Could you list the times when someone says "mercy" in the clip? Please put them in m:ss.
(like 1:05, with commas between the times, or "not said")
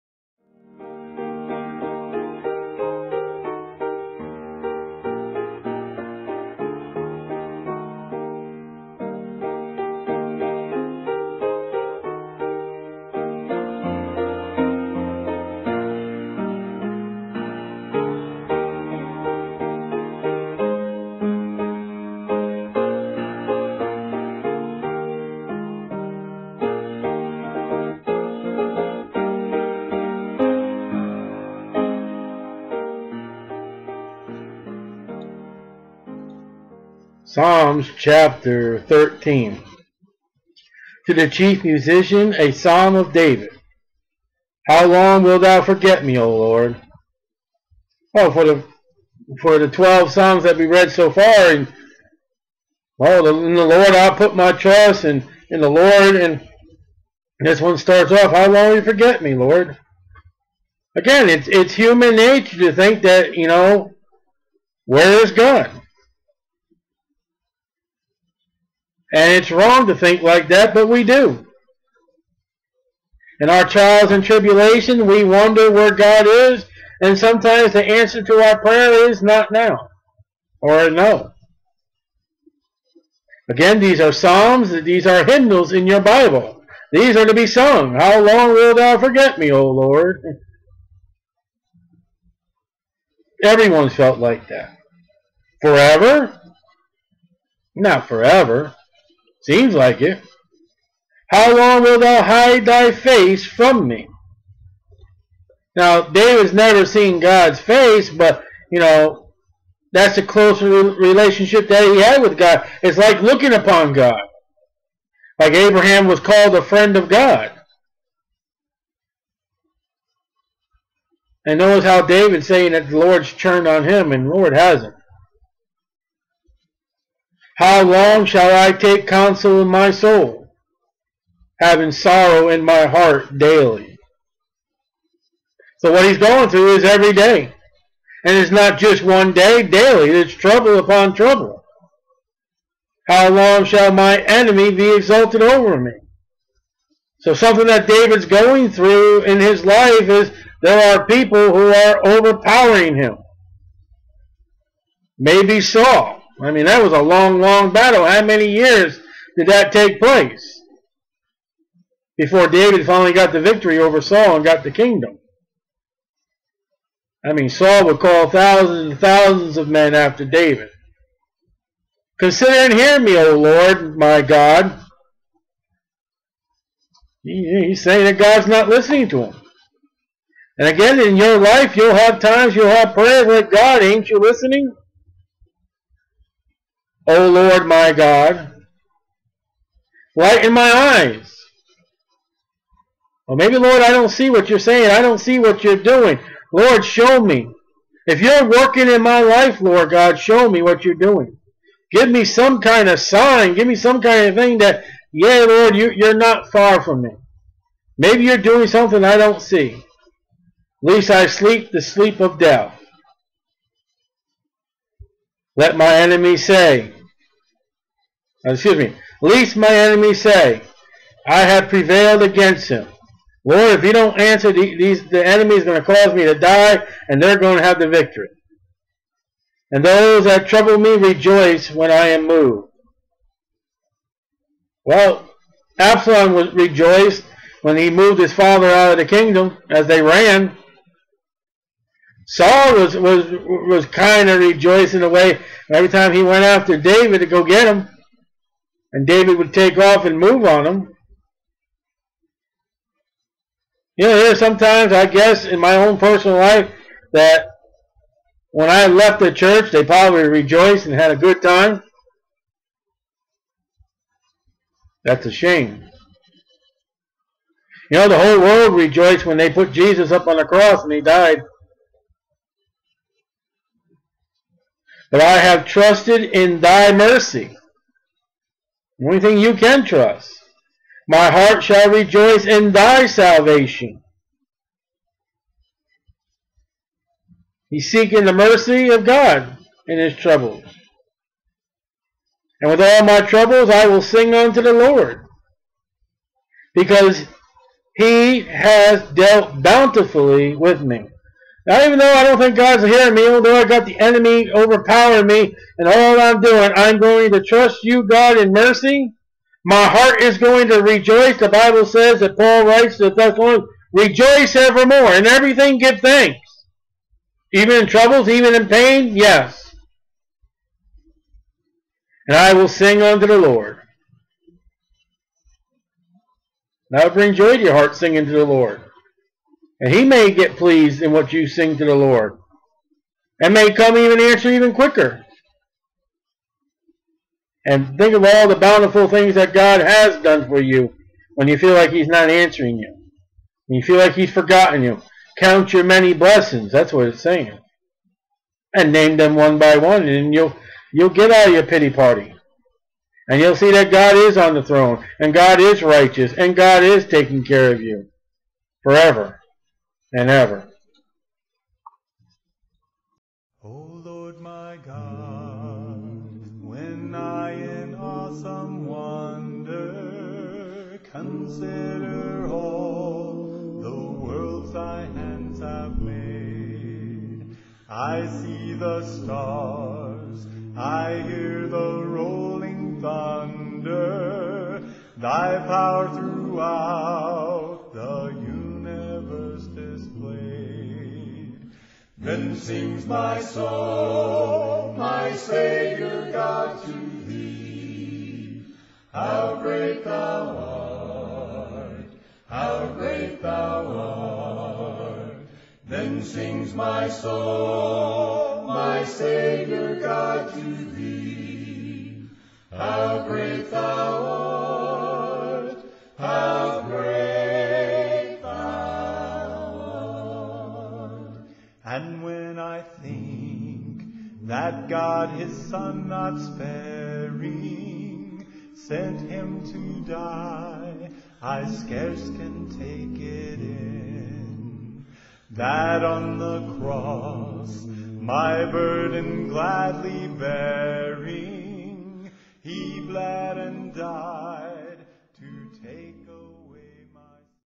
4:36, 4:48, 5:08.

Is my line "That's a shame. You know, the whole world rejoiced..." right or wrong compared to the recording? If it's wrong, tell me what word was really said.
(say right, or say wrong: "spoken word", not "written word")
right.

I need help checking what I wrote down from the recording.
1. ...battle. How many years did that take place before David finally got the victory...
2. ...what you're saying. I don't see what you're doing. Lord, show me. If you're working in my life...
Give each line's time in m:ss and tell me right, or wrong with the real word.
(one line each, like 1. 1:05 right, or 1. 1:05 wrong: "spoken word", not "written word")
1. 2:37 right
2. 3:14 right.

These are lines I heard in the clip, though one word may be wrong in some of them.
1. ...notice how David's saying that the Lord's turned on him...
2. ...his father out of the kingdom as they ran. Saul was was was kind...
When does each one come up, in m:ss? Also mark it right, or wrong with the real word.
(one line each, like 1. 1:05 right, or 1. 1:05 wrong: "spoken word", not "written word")
1. 2:01 right
2. 3:58 right.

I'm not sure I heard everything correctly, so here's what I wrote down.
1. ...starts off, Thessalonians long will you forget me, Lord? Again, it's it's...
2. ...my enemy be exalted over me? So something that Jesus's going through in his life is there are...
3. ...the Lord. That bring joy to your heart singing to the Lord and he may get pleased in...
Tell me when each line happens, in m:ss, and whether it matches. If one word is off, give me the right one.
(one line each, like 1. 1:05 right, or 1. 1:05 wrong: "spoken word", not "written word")
1. 0:57 wrong: "How", not "Thessalonians"
2. 2:23 wrong: "David", not "Jesus"
3. 5:23 right.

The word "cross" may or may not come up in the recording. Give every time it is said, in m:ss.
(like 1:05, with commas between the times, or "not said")
4:30, 7:16.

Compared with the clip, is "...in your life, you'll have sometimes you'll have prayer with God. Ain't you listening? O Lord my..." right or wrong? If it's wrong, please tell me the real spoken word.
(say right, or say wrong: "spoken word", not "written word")
wrong: "times", not "sometimes".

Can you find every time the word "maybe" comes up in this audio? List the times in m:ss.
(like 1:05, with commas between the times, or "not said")
2:35, 3:13, 3:27.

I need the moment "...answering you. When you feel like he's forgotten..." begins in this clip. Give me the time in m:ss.
5:42.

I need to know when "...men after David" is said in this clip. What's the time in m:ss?
2:49.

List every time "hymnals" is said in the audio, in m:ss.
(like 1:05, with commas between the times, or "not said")
1:25.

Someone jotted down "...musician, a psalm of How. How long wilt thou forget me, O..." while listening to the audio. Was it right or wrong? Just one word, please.
wrong.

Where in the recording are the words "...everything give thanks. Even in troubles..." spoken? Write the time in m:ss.
5:15.